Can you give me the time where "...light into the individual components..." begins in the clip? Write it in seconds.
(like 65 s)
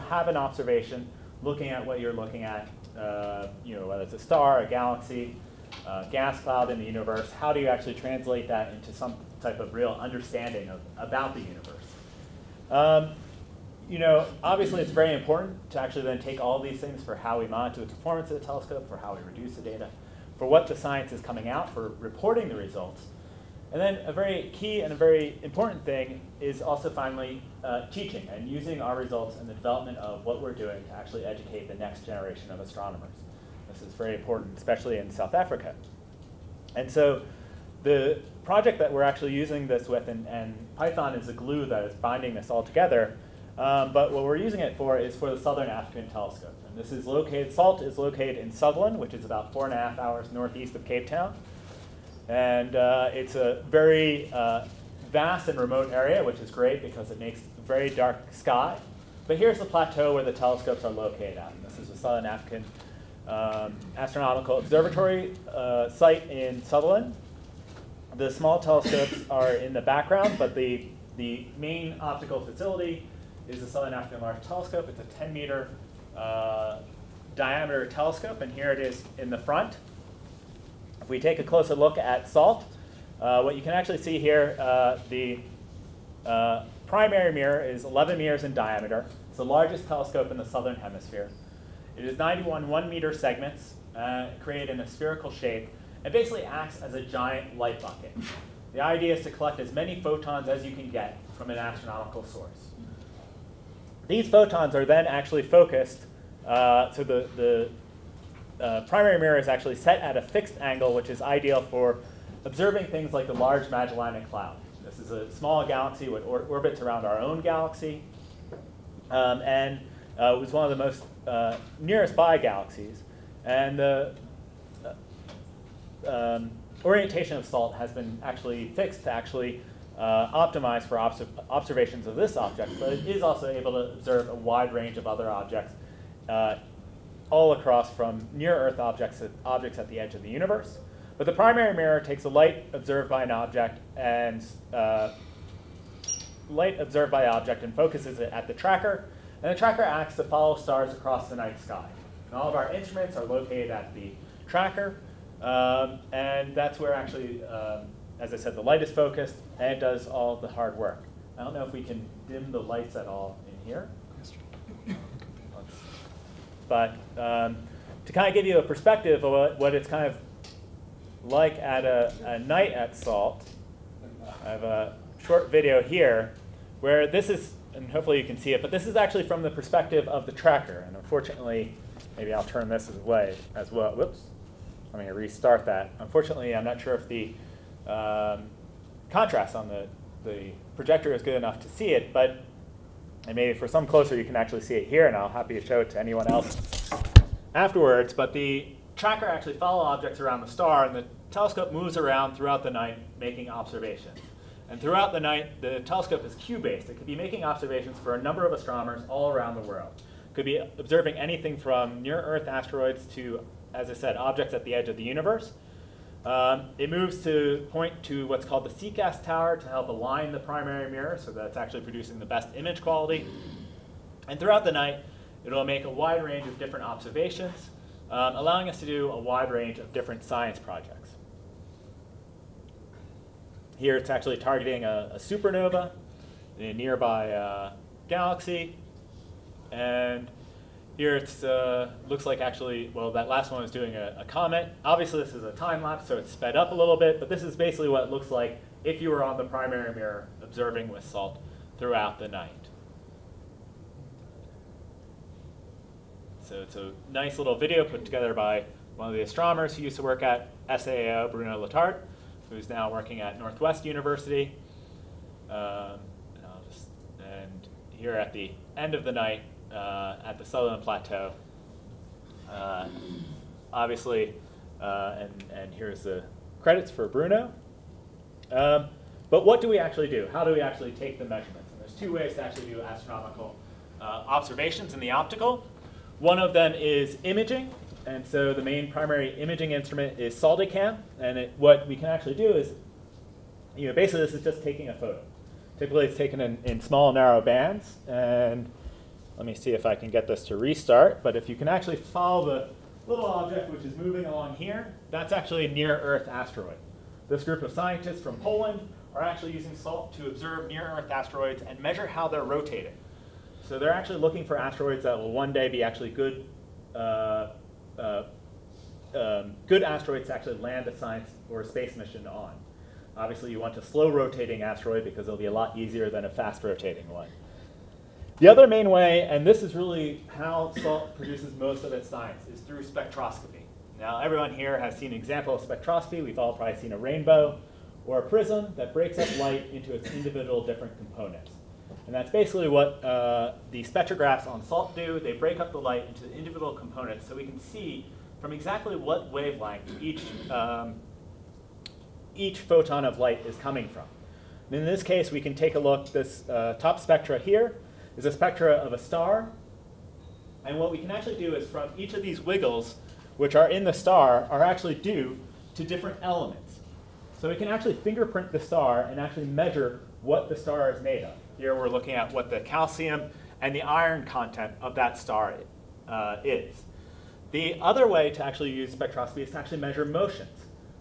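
345 s.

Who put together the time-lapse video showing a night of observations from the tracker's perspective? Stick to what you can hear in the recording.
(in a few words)
Bruno Letarte.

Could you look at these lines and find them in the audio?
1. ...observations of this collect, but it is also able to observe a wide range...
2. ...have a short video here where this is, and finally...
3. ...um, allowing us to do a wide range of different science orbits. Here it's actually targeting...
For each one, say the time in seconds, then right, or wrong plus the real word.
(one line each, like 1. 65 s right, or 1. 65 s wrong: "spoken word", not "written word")
1. 131 s wrong: "object", not "collect"
2. 174 s wrong: "hopefully", not "finally"
3. 228 s wrong: "projects", not "orbits".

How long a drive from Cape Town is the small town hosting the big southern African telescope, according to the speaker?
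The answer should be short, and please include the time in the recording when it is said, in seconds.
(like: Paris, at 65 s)
4.5 hours, at 49 s.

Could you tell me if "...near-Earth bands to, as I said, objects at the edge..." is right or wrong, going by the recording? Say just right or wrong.
wrong.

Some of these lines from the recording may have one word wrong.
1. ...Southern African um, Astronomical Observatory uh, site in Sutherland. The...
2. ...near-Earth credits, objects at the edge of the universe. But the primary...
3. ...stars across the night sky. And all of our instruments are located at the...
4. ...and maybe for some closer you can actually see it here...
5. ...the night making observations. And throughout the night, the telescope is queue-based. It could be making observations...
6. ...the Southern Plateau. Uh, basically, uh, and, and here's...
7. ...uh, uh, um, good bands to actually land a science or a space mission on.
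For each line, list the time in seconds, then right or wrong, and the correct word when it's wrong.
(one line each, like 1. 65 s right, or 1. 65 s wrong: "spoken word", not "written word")
1. 61 s right
2. 138 s wrong: "objects", not "credits"
3. 150 s right
4. 193 s right
5. 202 s right
6. 270 s wrong: "obviously", not "basically"
7. 316 s wrong: "asteroids", not "bands".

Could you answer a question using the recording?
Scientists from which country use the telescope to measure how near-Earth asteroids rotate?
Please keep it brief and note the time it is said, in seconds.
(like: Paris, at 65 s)
Poland, at 308 s.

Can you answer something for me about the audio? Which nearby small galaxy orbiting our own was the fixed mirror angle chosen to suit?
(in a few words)
Large Magellanic Cloud.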